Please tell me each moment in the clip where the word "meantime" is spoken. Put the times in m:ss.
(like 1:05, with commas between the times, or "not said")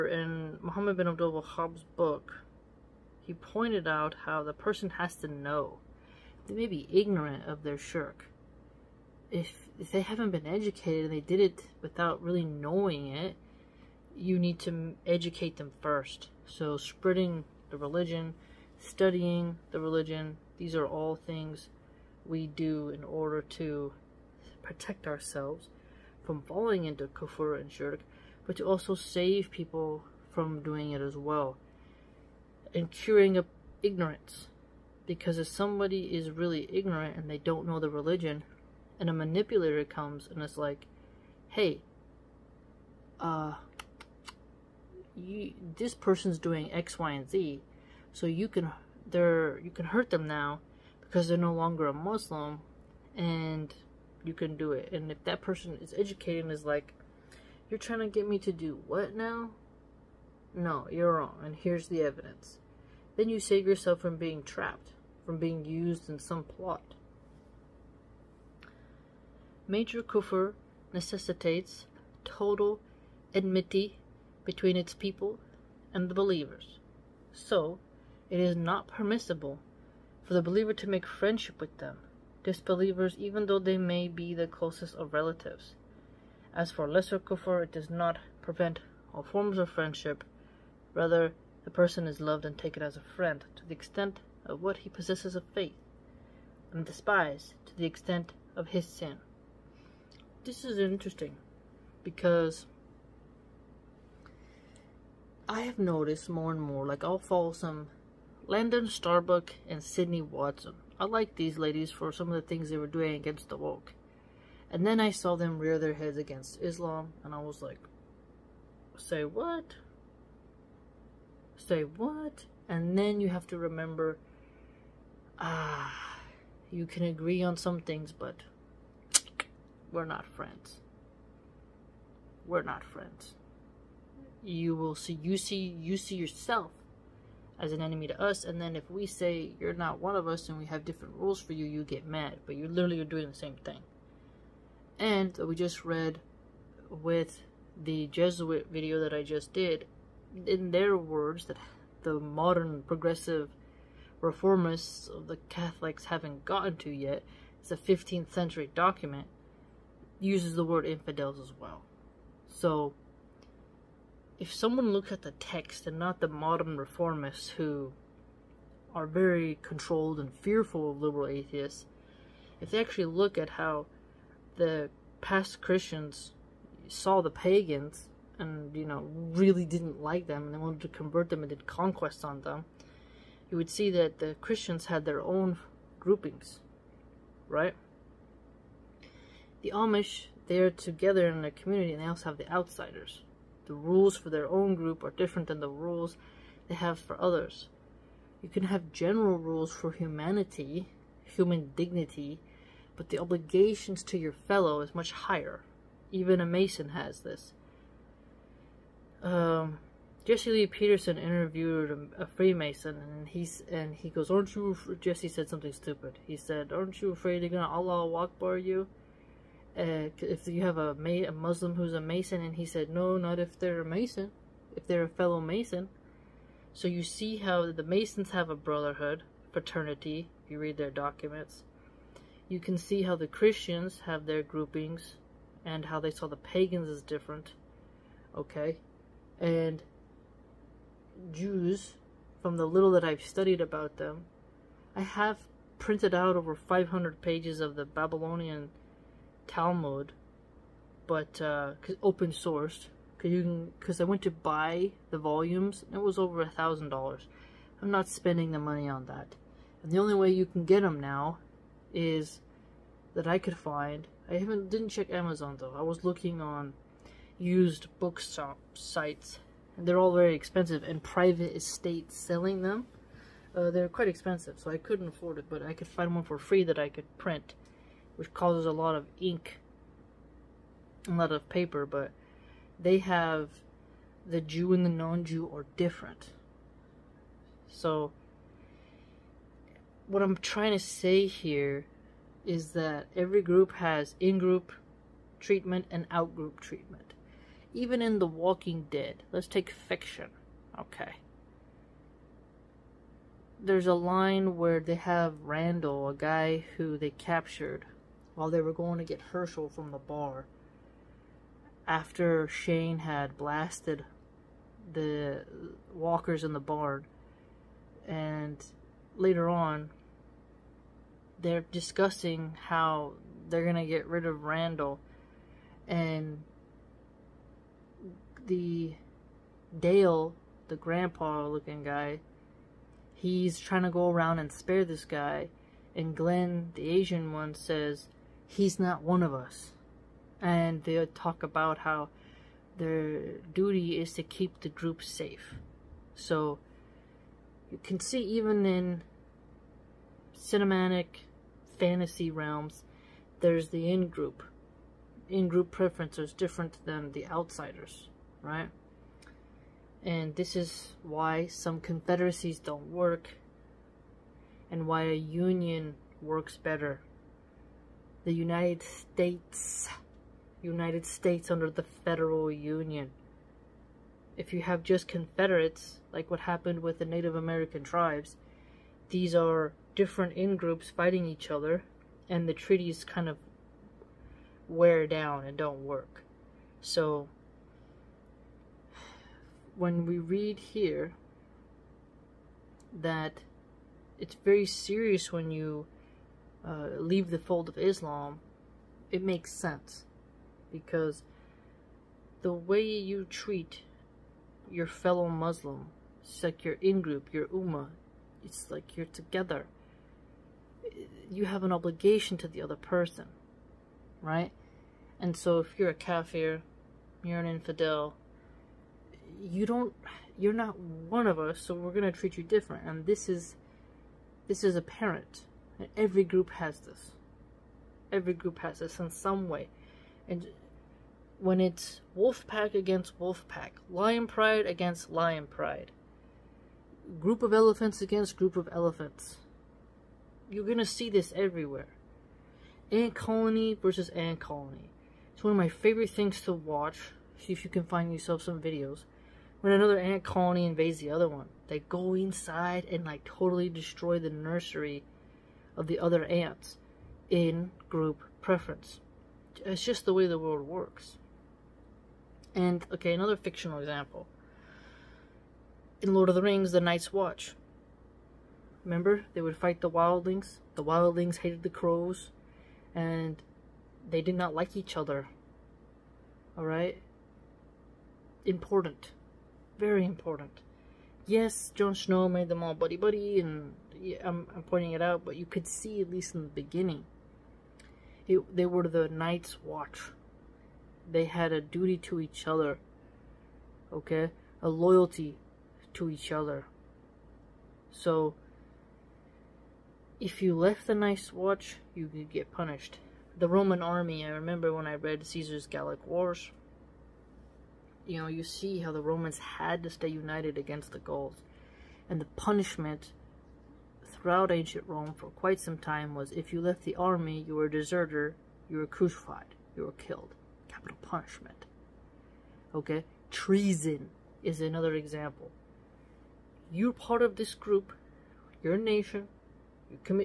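not said.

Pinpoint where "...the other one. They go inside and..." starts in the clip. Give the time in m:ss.
7:30.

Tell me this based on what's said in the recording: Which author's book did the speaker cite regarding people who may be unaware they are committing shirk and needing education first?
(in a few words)
Muhammad bin Abdul Wahhab.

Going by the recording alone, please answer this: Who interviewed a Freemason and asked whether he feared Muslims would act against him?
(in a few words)
Jesse Lee Peterson.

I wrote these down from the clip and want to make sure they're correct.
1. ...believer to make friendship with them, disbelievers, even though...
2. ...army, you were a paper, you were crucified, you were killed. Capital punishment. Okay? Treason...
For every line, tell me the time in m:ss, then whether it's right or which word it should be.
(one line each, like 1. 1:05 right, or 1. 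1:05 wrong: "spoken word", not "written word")
1. 1:20 right
2. 8:36 wrong: "deserter", not "paper".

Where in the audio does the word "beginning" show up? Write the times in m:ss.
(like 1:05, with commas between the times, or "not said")
8:06.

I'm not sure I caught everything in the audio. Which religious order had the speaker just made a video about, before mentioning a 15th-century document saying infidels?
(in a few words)
Jesuit.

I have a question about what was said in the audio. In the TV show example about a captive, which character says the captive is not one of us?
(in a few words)
Glenn.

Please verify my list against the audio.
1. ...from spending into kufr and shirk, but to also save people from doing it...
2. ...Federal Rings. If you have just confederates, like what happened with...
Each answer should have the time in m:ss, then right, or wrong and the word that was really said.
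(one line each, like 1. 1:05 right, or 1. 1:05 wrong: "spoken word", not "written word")
1. 0:26 wrong: "falling", not "spending"
2. 6:11 wrong: "Union", not "Rings".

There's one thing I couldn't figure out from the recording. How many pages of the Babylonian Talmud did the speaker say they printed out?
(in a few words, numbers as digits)
over 500.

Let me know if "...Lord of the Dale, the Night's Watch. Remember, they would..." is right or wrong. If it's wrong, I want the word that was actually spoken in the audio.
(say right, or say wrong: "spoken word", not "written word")
wrong: "Rings", not "Dale".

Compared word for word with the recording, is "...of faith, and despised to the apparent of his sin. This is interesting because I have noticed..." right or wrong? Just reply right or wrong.
wrong.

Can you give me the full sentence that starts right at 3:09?
The Amish, they're together in a community and they also have the outsiders.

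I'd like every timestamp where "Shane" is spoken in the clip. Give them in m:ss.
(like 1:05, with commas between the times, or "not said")
5:12.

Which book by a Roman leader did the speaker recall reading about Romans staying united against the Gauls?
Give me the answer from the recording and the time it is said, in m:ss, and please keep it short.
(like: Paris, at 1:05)
Caesar's Gallic Wars, at 8:25.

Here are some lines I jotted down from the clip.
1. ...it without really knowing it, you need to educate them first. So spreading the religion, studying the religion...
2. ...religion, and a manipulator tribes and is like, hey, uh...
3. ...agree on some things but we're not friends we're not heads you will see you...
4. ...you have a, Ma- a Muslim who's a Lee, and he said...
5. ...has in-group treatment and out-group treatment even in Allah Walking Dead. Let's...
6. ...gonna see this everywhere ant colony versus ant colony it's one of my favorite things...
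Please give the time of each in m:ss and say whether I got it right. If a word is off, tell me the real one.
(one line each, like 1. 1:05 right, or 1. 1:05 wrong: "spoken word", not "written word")
1. 0:11 right
2. 0:37 wrong: "comes", not "tribes"
3. 2:07 wrong: "friends", not "heads"
4. 3:40 wrong: "Mason", not "Lee"
5. 4:53 wrong: "The", not "Allah"
6. 7:20 right.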